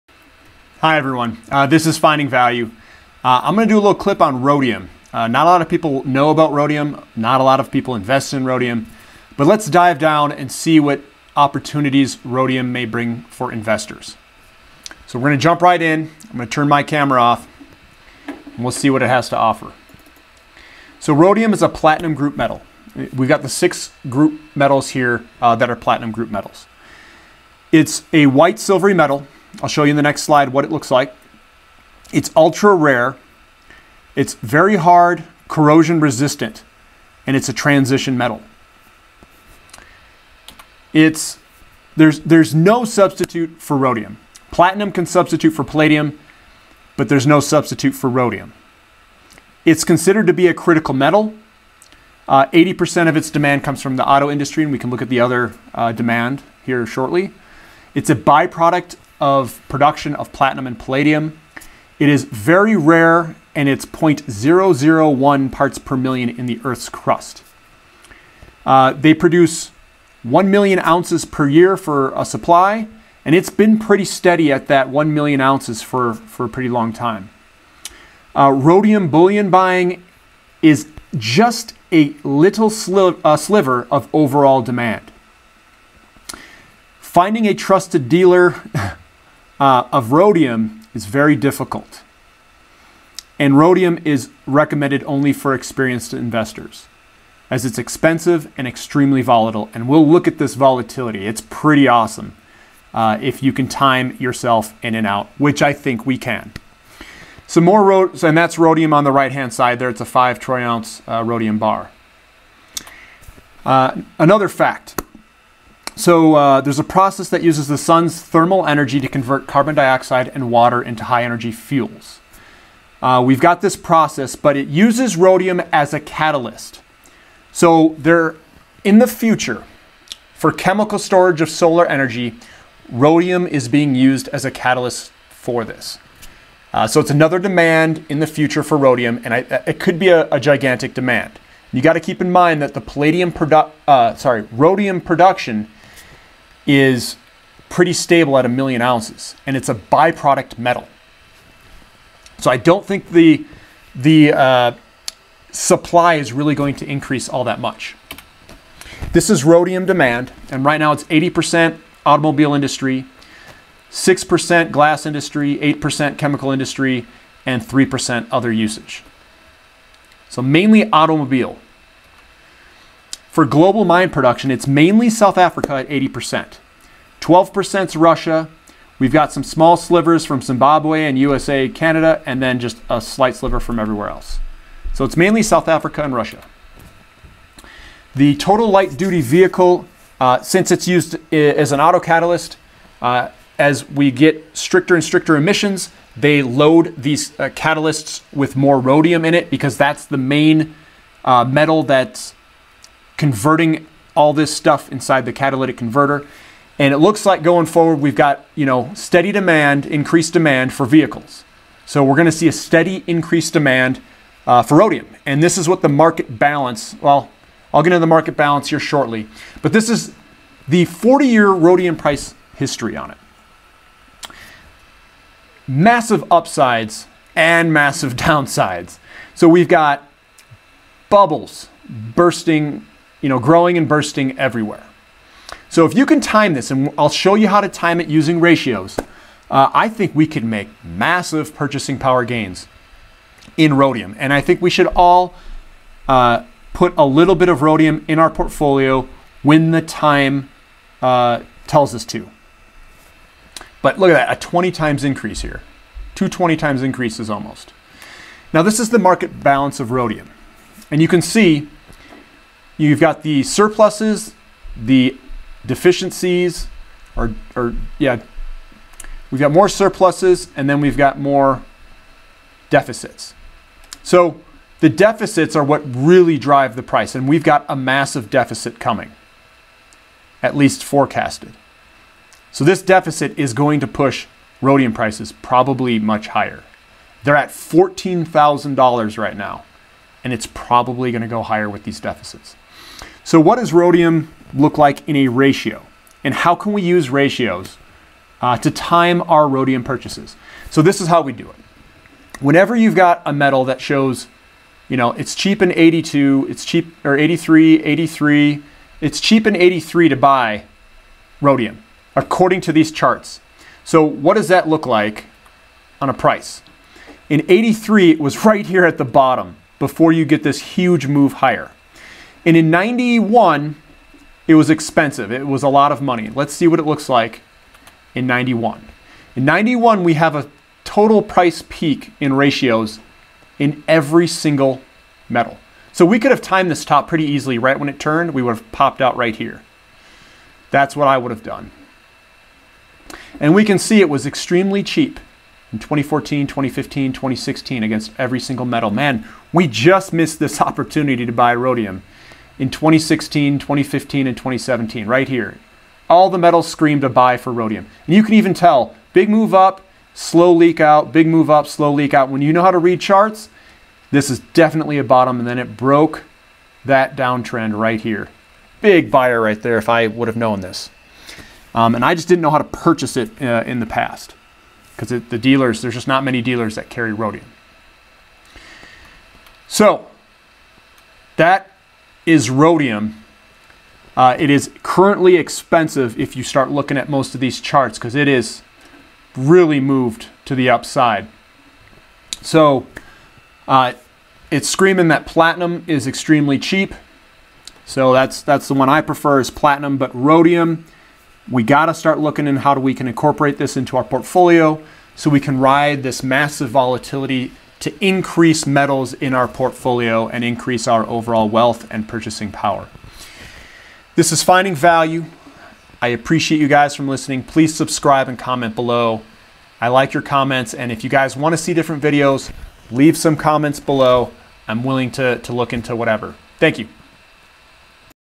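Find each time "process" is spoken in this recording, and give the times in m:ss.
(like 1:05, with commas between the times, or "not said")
1:56, 2:03.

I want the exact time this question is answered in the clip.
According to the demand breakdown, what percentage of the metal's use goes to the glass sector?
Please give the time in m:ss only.
2:43.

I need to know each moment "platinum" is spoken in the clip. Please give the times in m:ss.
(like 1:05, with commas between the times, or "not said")
0:21, 0:25, 0:44, 1:00, 6:35, 6:39.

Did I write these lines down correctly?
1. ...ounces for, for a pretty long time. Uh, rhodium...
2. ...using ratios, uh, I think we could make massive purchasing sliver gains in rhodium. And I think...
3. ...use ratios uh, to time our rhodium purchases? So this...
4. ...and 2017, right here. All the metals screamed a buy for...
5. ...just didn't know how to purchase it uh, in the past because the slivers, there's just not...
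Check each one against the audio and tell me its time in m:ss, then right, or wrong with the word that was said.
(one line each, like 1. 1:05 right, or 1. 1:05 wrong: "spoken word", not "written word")
1. 1:15 right
2. 3:58 wrong: "power", not "sliver"
3. 4:56 right
4. 5:54 right
5. 6:12 wrong: "dealers", not "slivers".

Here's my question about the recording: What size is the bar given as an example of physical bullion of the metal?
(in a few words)
5 troy ounce.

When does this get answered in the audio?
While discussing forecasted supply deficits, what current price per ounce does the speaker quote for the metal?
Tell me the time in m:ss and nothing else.
4:47.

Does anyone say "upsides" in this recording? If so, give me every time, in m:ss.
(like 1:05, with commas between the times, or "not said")
3:46, 6:30.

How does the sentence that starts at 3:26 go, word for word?
And it looks like going forward, we've got, you know, steady demand, increased demand for vehicles.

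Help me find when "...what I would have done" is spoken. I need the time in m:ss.
5:40.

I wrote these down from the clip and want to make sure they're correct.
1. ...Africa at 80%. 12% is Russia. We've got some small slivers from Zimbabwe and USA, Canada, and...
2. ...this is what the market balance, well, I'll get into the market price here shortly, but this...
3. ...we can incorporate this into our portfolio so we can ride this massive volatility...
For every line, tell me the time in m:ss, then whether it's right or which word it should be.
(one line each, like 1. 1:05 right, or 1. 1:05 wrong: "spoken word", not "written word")
1. 2:55 right
2. 3:35 wrong: "balance", not "price"
3. 6:42 right.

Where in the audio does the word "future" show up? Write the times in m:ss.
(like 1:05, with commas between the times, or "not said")
2:09, 2:18.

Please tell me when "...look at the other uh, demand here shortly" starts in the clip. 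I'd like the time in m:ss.
0:54.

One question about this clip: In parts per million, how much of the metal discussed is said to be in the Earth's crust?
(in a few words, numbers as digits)
0.001 parts per million.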